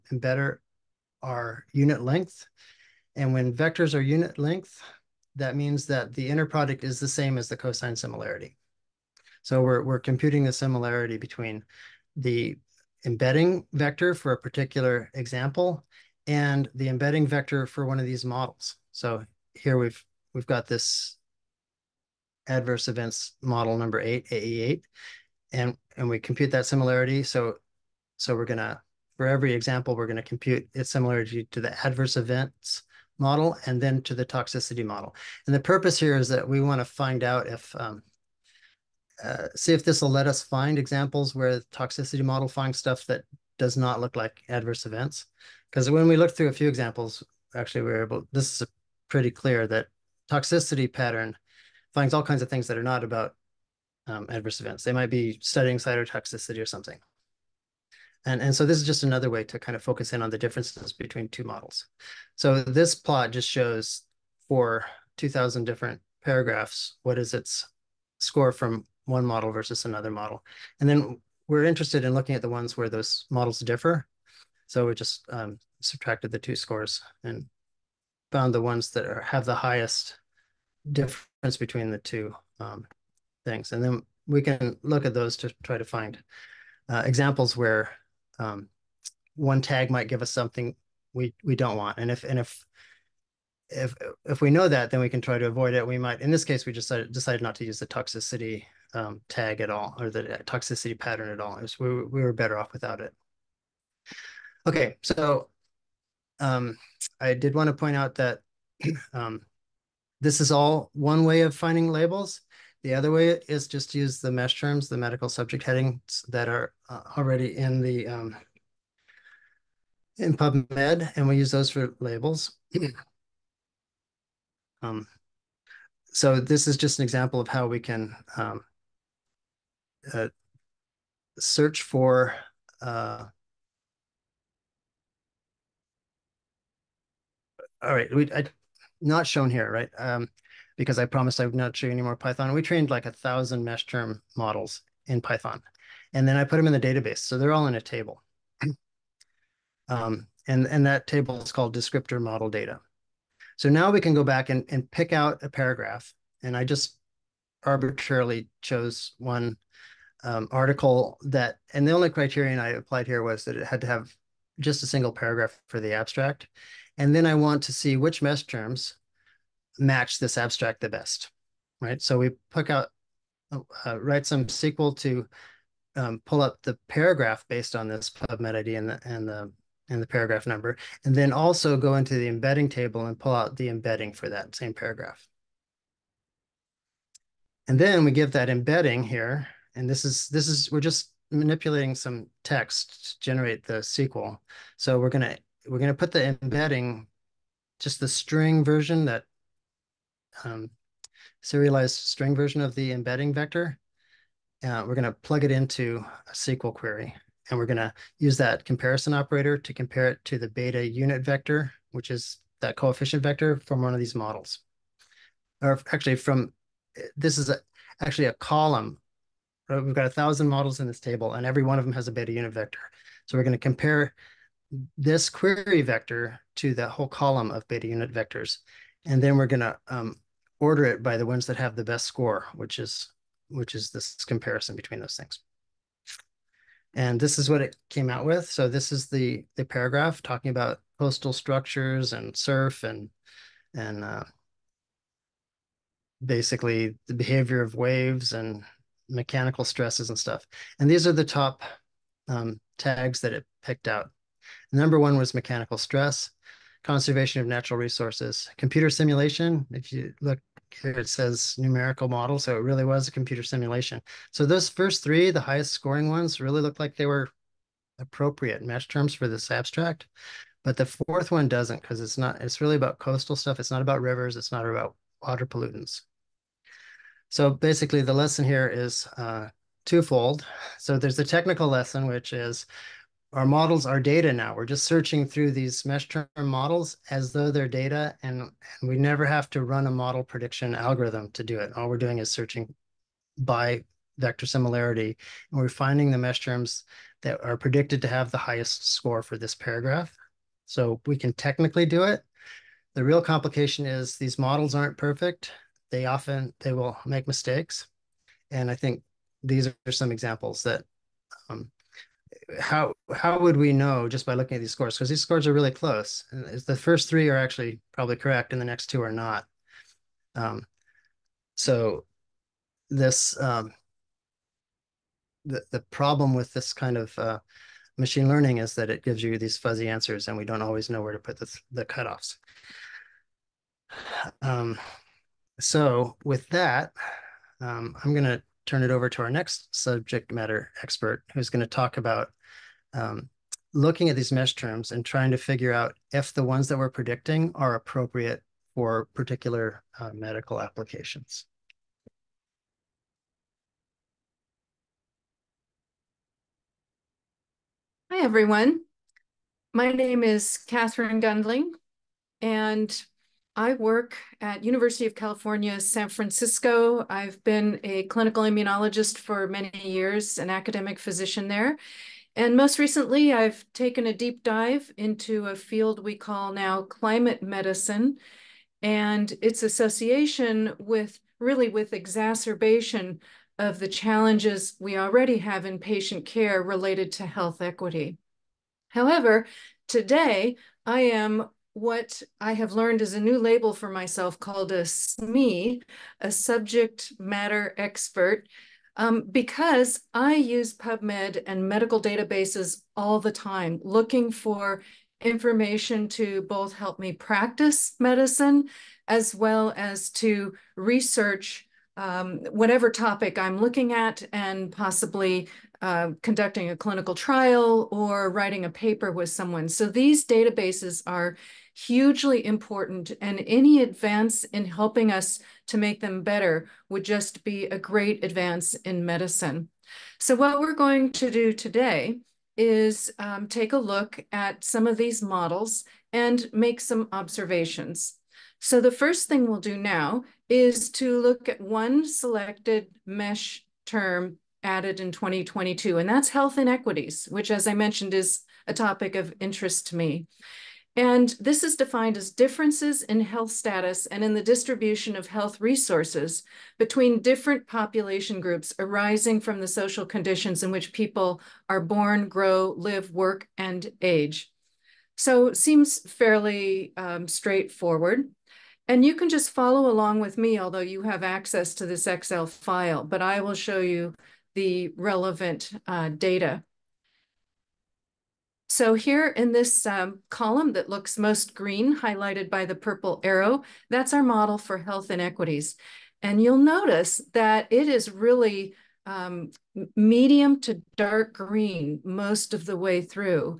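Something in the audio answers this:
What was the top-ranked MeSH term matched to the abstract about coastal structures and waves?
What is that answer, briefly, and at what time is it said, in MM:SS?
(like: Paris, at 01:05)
mechanical stress, at 04:15.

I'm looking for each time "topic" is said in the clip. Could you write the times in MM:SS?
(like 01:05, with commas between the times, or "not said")
06:52, 07:28.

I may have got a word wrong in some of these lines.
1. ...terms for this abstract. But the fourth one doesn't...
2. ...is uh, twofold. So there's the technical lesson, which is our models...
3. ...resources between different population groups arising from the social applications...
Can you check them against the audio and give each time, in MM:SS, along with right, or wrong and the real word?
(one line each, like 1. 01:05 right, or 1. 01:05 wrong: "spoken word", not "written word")
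1. 04:28 right
2. 04:38 right
3. 07:35 wrong: "conditions", not "applications".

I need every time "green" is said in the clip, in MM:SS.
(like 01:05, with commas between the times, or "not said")
08:01, 08:11.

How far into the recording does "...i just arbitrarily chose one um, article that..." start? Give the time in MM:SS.
02:36.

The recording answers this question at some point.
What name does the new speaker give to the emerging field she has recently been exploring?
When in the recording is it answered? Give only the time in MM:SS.
06:16.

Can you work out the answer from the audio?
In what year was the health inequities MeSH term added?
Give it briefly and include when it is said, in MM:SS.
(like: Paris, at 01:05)
2022, at 07:25.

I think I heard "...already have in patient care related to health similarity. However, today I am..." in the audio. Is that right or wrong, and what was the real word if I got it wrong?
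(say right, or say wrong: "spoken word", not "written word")
wrong: "equity", not "similarity".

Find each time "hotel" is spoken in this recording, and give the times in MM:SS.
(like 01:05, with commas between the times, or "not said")
not said.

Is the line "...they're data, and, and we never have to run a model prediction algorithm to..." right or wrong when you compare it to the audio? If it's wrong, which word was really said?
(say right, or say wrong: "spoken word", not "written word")
right.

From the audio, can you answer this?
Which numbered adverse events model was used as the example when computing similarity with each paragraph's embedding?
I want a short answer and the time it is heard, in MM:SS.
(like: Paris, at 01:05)
AE8, at 00:24.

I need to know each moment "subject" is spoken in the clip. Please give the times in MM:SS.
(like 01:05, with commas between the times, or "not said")
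01:55, 05:39, 06:36.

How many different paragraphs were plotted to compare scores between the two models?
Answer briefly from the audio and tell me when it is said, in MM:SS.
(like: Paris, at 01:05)
2000, at 01:05.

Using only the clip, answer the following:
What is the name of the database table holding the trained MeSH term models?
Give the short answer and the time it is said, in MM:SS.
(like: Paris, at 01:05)
descriptor model data, at 02:31.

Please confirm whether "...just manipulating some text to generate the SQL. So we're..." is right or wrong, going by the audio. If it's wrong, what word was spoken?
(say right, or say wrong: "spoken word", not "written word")
right.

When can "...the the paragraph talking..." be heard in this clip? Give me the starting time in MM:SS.
03:59.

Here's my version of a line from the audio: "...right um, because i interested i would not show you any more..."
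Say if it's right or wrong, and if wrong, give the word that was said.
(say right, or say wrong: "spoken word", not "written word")
wrong: "promised", not "interested".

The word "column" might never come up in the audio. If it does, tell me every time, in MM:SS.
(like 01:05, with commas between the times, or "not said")
03:38, 03:47, 08:00.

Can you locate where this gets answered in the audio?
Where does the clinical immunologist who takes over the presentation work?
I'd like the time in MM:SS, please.
06:04.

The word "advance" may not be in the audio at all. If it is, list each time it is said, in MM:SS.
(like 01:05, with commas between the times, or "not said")
07:03, 07:08.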